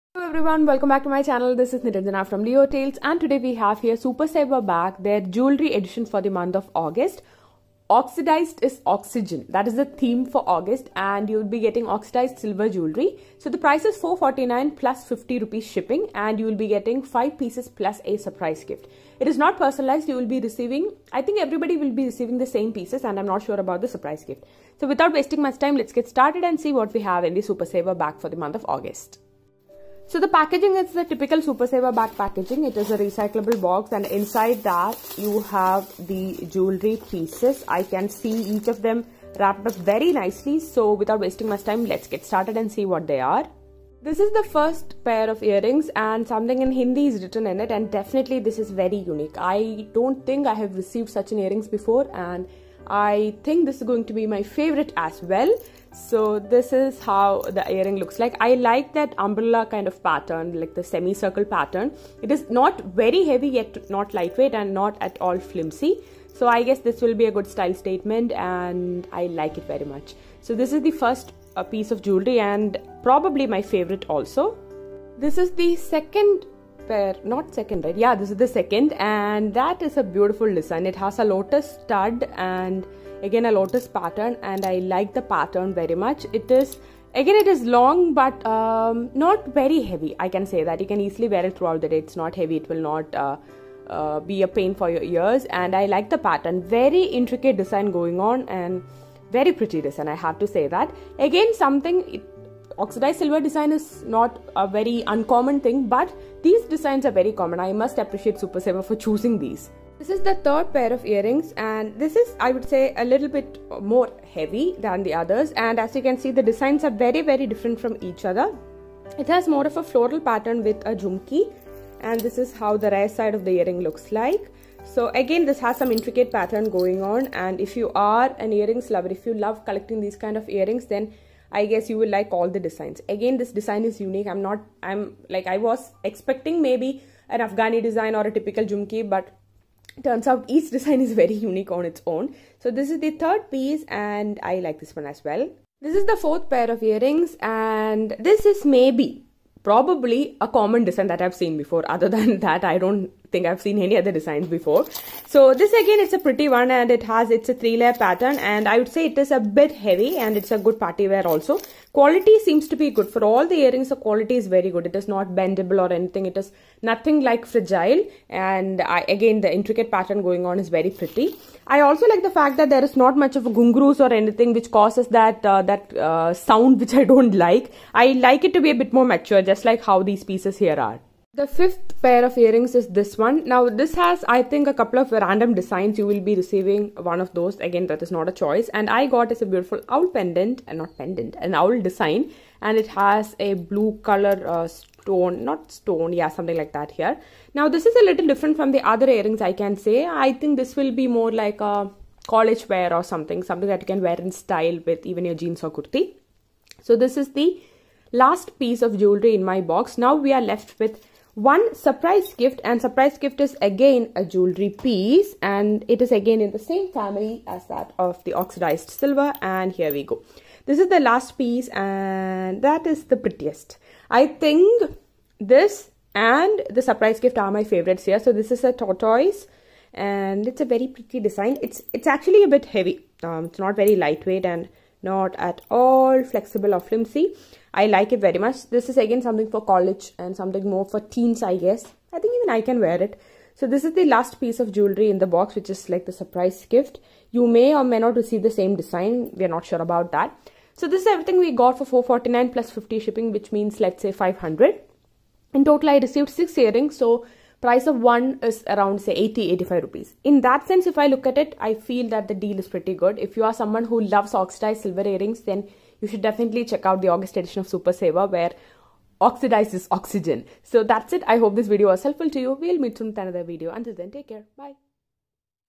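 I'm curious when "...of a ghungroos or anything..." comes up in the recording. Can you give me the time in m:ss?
2:53.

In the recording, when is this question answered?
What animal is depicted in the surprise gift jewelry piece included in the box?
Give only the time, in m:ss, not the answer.
3:48.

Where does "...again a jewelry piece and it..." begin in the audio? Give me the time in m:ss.
3:33.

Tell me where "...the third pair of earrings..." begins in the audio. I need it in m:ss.
1:50.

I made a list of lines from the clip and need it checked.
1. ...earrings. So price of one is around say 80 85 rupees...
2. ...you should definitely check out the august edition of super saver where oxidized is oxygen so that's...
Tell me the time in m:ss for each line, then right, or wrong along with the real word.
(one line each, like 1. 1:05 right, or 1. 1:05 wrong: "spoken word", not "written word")
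1. 4:16 right
2. 4:26 right.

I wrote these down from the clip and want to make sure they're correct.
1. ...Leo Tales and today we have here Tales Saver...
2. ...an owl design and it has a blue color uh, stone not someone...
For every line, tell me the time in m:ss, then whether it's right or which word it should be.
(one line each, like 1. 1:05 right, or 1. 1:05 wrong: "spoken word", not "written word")
1. 0:02 wrong: "Super", not "Tales"
2. 3:11 wrong: "stone", not "someone".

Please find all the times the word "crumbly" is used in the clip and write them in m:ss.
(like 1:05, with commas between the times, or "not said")
not said.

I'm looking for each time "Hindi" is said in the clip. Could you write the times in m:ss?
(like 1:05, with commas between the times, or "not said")
0:46.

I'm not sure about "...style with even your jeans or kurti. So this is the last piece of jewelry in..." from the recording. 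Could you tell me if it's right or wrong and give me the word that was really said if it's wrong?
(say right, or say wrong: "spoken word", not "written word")
right.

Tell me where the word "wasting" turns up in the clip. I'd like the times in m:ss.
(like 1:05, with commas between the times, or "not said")
0:25, 0:41.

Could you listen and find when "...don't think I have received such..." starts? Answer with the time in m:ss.
0:49.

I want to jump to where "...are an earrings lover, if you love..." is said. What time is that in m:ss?
2:07.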